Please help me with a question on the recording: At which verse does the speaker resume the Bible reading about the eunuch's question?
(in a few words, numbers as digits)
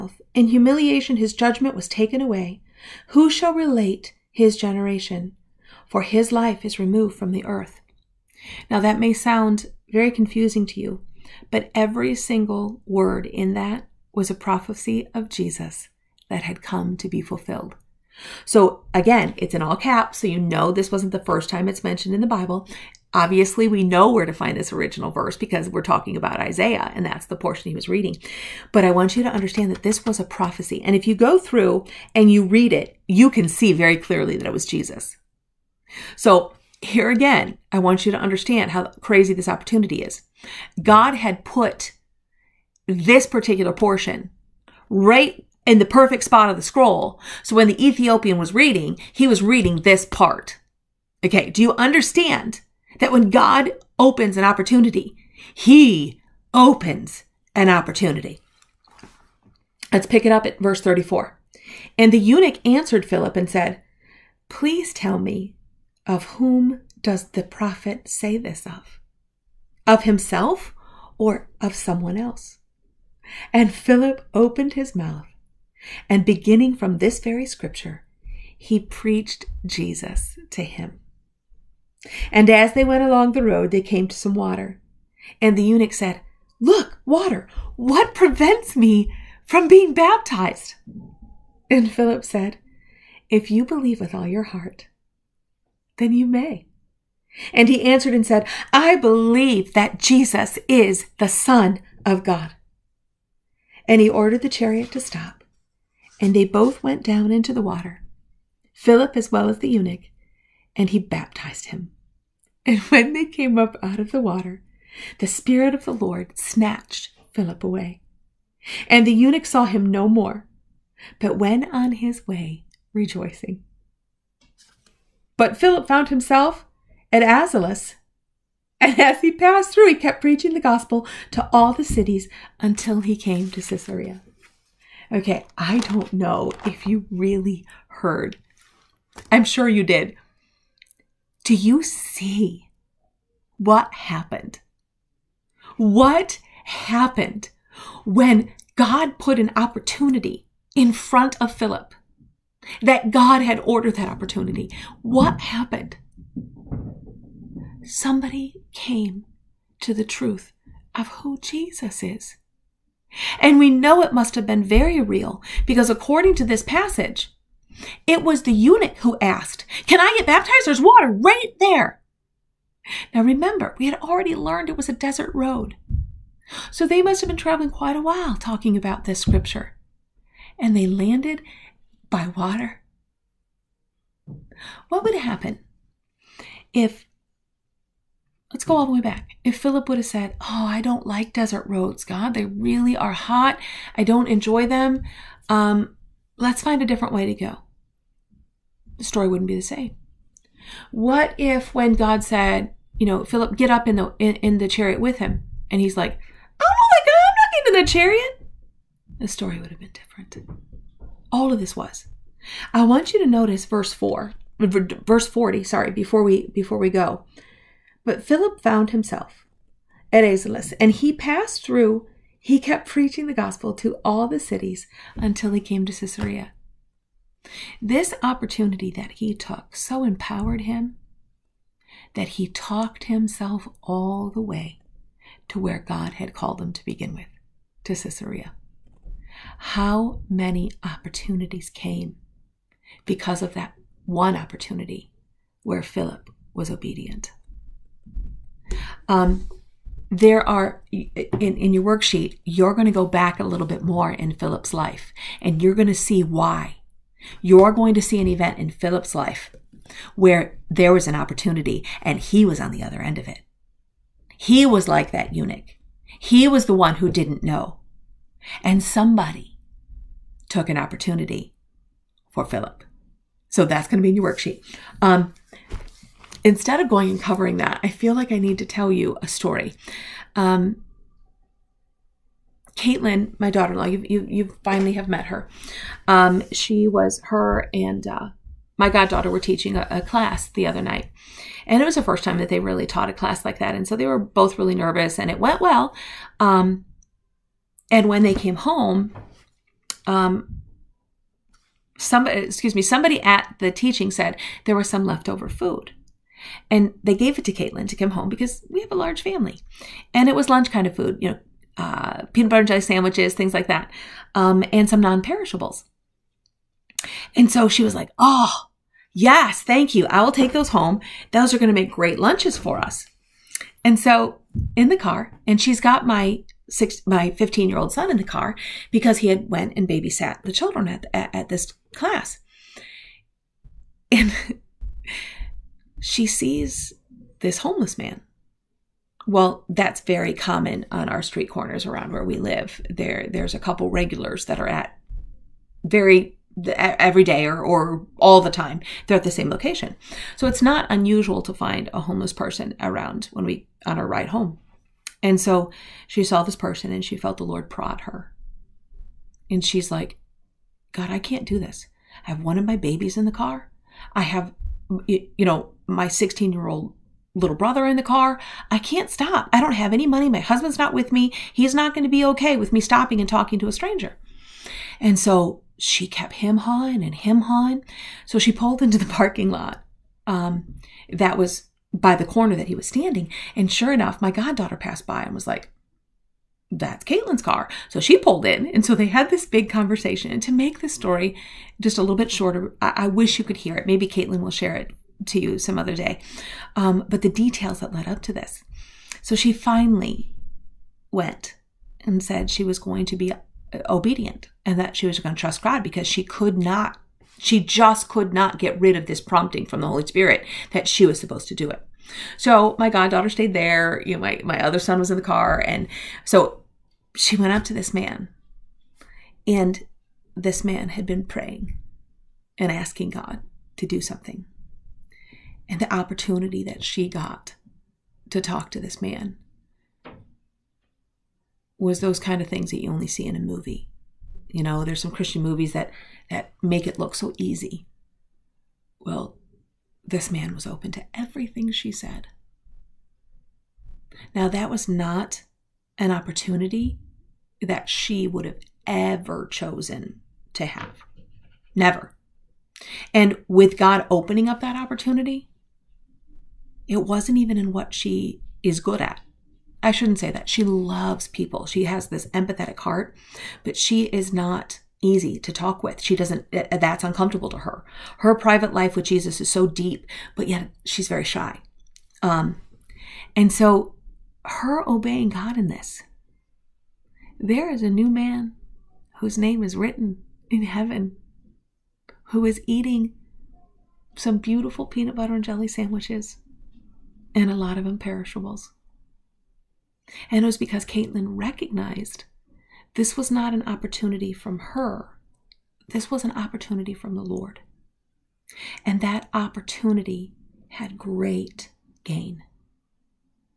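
34.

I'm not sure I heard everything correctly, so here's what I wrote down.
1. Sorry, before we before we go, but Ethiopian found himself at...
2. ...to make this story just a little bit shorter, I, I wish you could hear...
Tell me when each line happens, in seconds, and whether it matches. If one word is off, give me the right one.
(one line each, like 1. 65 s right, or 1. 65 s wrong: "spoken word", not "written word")
1. 215 s wrong: "Philip", not "Ethiopian"
2. 390 s right.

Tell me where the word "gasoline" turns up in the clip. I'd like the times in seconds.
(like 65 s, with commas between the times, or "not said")
not said.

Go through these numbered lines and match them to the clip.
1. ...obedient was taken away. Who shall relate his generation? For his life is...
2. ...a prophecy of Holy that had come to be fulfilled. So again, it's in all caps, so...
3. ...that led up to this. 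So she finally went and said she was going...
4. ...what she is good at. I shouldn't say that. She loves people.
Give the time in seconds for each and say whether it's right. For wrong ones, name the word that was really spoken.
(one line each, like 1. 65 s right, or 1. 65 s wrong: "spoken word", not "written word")
1. 1 s wrong: "judgment", not "obedient"
2. 14 s wrong: "Jesus", not "Holy"
3. 397 s right
4. 457 s right.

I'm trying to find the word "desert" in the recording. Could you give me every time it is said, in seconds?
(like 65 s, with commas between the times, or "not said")
174 s, 191 s.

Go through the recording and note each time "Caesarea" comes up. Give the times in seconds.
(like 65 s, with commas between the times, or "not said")
133 s, 225 s, 237 s.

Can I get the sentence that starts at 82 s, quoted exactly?
And as they went along the road, they came to some water.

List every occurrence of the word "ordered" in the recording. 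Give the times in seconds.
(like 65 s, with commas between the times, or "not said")
104 s, 153 s.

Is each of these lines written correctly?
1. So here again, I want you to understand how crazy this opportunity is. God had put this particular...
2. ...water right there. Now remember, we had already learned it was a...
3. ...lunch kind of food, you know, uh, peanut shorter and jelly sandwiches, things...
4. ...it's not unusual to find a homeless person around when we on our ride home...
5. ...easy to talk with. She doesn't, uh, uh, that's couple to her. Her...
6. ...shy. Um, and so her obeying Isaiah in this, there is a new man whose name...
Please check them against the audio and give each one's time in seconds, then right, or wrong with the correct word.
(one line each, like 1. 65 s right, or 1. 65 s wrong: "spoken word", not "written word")
1. 36 s right
2. 170 s right
3. 310 s wrong: "butter", not "shorter"
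4. 350 s right
5. 465 s wrong: "uncomfortable", not "couple"
6. 471 s wrong: "God", not "Isaiah".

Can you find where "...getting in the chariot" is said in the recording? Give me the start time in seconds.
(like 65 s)
207 s.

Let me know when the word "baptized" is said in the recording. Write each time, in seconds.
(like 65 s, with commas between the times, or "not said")
89 s, 110 s, 170 s.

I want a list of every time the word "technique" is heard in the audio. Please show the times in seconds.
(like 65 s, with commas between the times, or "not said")
not said.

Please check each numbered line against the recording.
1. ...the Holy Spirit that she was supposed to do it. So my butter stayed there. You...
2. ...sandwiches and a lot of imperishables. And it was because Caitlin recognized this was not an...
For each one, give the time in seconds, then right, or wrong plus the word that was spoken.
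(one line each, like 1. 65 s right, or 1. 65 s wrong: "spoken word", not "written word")
1. 409 s wrong: "goddaughter", not "butter"
2. 485 s right.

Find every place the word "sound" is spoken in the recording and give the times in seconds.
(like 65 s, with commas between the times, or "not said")
9 s.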